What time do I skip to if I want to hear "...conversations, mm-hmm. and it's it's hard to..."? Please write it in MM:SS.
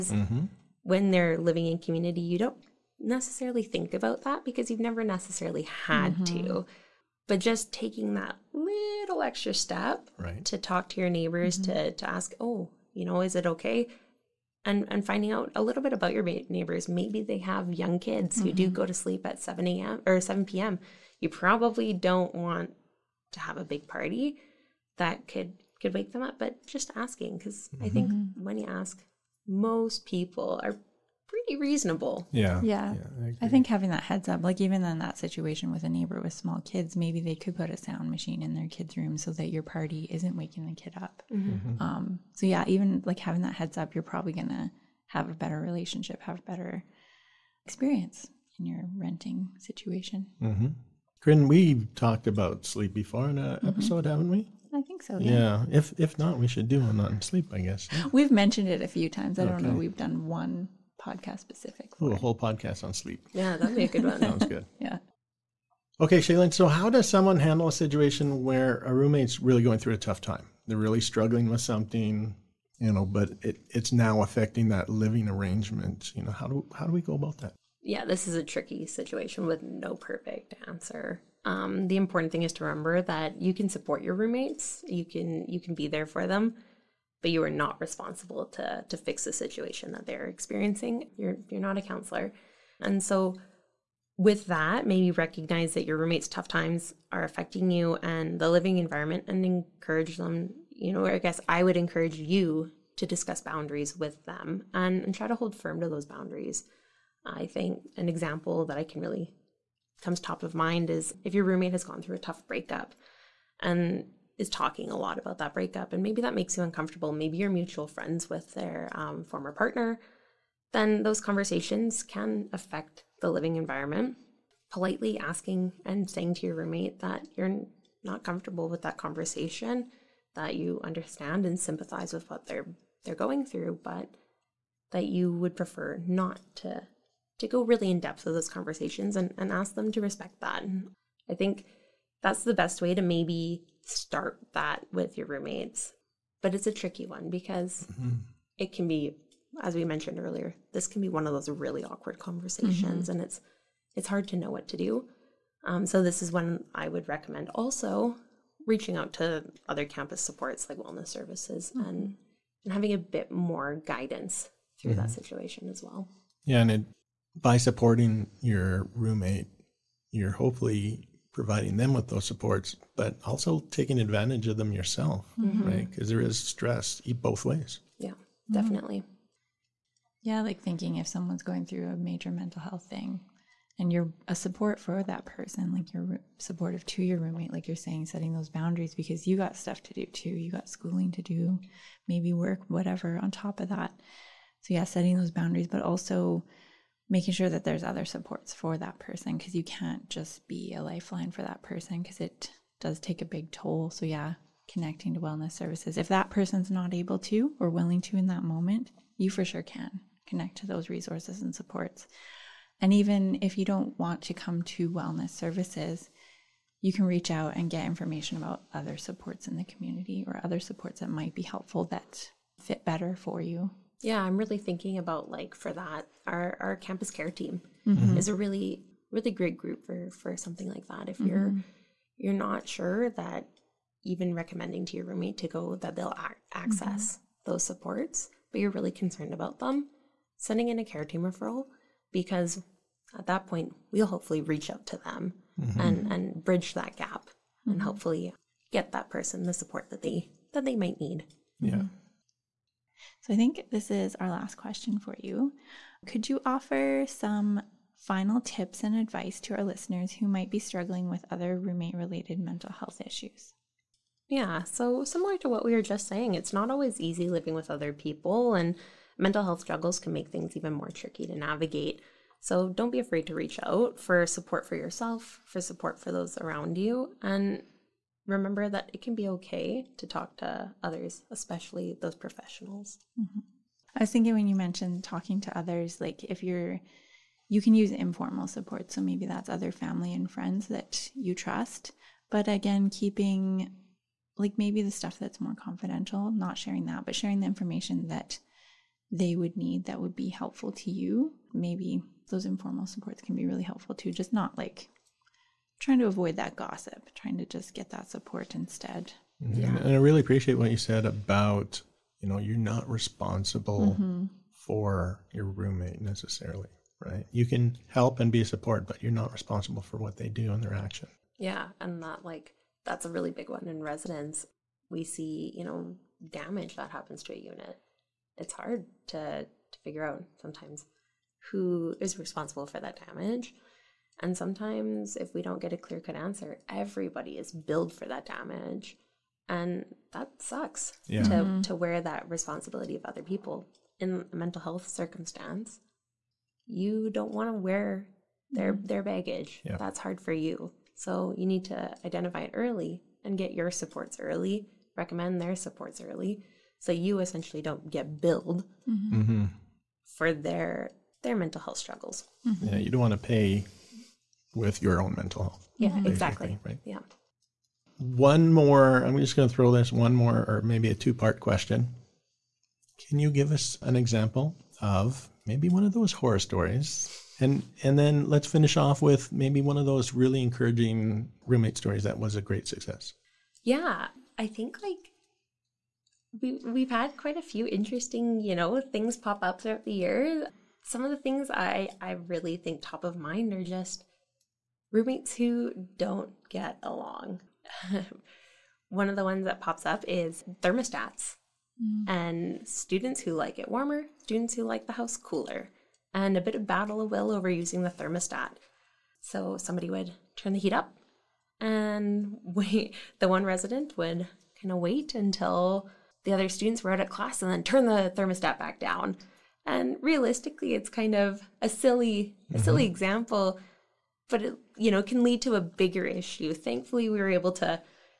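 02:32.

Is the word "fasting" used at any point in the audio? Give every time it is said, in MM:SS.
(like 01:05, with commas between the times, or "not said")
not said.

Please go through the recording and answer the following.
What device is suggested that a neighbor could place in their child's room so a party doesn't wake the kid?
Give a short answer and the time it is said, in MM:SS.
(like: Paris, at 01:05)
sound machine, at 00:37.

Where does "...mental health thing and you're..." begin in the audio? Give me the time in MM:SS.
03:02.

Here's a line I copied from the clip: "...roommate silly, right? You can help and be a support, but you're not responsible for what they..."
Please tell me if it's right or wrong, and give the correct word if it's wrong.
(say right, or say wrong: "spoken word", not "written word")
wrong: "necessarily", not "silly".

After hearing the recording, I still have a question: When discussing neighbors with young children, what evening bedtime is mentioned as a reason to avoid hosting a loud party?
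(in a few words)
7 p.m.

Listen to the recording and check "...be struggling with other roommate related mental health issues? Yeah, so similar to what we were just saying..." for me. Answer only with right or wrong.
right.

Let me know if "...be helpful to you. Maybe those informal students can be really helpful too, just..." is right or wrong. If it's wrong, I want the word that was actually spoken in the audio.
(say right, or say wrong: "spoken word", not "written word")
wrong: "supports", not "students".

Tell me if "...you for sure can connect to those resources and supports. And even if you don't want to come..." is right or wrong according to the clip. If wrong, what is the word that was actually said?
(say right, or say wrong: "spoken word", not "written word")
right.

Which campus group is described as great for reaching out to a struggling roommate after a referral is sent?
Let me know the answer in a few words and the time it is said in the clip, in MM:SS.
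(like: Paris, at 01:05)
campus care team, at 03:46.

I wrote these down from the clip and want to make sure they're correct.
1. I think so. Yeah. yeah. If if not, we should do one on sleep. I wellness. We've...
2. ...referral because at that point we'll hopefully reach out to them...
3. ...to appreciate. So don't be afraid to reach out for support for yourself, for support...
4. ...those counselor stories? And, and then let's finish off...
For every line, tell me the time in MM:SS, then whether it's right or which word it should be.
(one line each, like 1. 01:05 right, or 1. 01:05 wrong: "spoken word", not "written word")
1. 00:54 wrong: "guess", not "wellness"
2. 04:01 right
3. 04:31 wrong: "navigate", not "appreciate"
4. 06:15 wrong: "horror", not "counselor".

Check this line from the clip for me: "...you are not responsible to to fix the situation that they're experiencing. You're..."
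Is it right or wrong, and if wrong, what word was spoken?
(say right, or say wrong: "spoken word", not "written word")
right.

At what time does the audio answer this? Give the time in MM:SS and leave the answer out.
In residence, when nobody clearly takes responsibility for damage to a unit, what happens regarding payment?
05:36.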